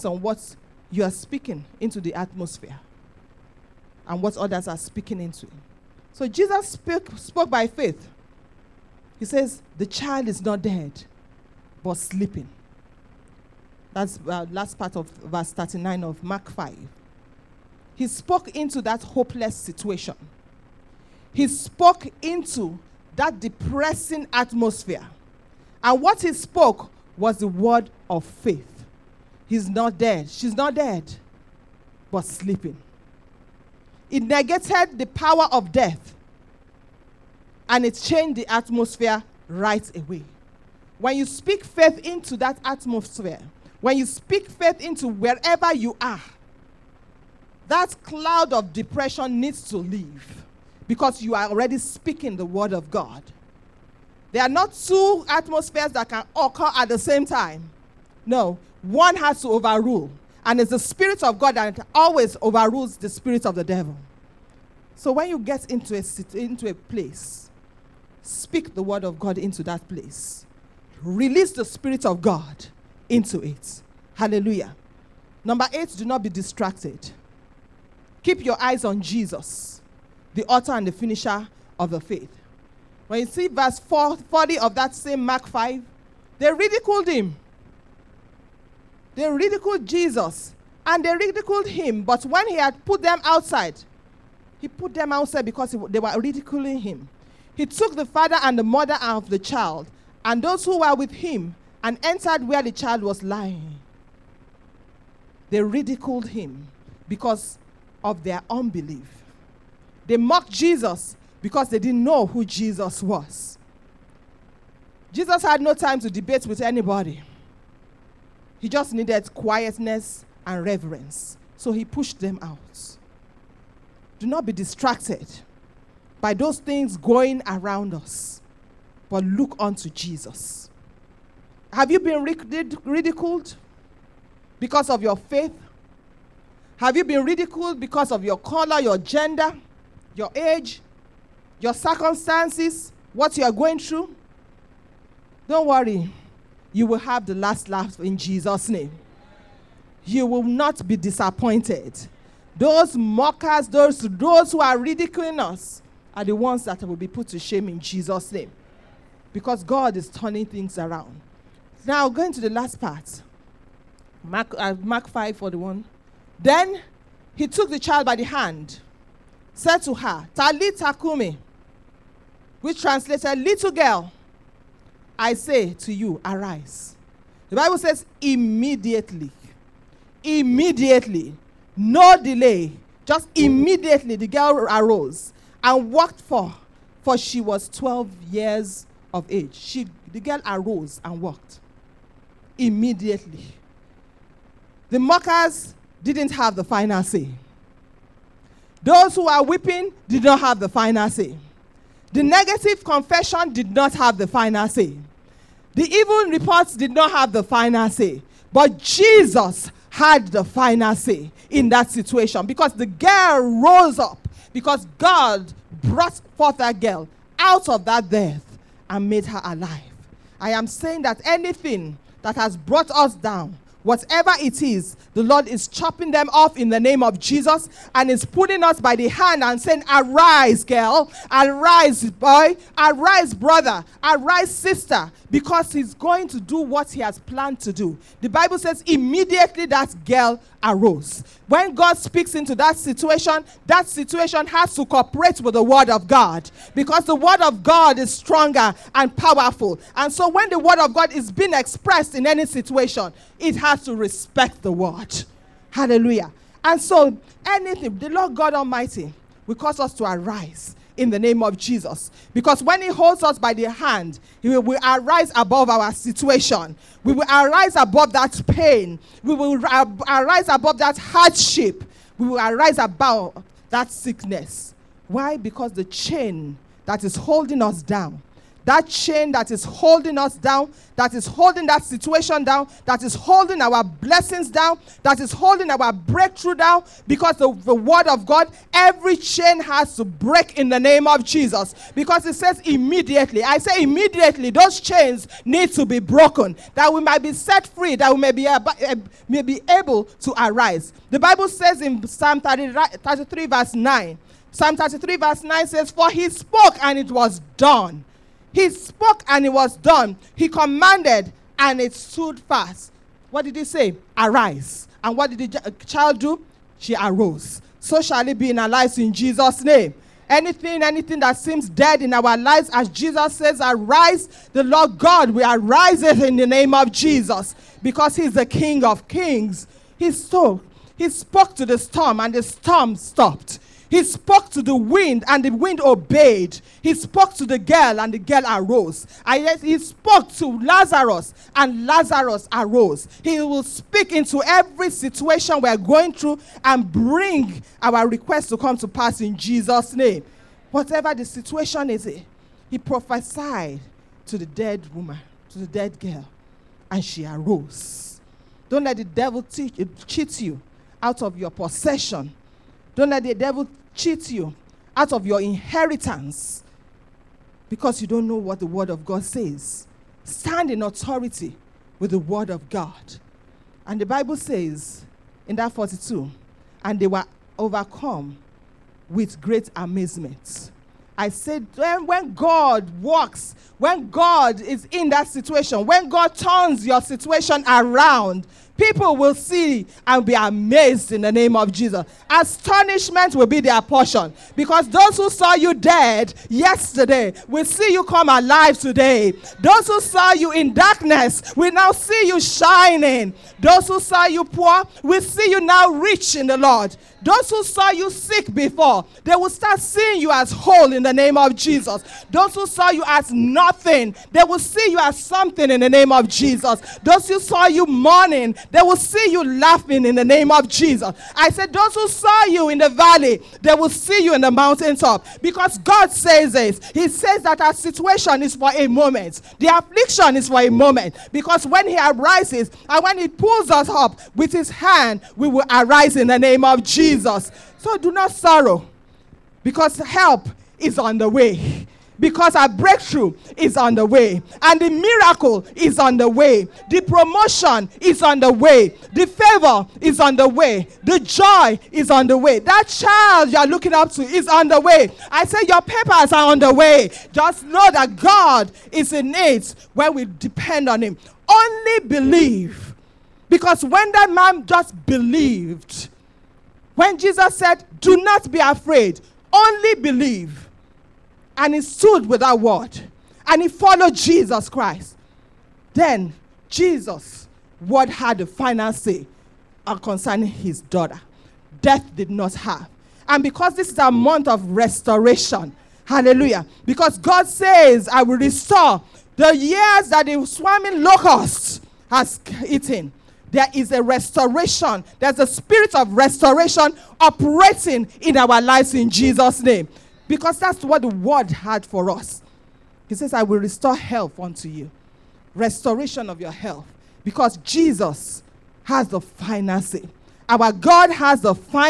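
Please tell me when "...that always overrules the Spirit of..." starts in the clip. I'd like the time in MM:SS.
01:01.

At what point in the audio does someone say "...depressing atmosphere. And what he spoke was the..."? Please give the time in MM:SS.
00:23.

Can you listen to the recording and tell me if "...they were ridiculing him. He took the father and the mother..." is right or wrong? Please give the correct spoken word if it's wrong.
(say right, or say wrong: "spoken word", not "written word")
right.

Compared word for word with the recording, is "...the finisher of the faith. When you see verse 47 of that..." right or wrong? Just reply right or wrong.
wrong.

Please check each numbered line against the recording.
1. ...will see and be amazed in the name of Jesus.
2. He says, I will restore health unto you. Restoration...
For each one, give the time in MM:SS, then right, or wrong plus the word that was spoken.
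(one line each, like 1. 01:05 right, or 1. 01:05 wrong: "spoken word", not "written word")
1. 06:29 right
2. 08:23 right.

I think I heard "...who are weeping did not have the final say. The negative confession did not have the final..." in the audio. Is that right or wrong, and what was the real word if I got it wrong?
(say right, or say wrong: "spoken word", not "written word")
right.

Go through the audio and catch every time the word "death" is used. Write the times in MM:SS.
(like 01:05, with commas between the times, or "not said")
00:35, 03:38, 08:01.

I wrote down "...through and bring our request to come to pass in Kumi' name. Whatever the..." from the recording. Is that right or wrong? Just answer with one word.
wrong.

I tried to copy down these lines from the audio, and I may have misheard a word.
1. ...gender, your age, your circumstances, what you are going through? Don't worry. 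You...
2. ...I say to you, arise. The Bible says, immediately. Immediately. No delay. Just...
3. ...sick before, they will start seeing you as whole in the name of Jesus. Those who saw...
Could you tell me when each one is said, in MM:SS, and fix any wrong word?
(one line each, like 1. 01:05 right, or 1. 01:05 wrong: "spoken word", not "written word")
1. 02:18 right
2. 02:55 right
3. 06:48 right.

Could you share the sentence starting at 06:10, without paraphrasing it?
Stand in authority with the Word of God.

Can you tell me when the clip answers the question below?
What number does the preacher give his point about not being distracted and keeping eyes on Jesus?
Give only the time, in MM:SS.
01:15.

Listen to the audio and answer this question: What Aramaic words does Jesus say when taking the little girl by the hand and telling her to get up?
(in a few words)
Talita Kumi.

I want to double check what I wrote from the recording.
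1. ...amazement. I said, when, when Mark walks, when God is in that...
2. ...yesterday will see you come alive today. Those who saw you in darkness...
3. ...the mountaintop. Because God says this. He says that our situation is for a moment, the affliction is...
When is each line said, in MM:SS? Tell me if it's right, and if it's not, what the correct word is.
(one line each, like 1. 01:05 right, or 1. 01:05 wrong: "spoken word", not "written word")
1. 06:19 wrong: "God", not "Mark"
2. 06:36 right
3. 07:04 right.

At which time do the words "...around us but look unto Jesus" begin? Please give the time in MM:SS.
02:07.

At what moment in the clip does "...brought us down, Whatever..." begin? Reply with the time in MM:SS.
03:42.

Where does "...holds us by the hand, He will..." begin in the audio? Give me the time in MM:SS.
04:22.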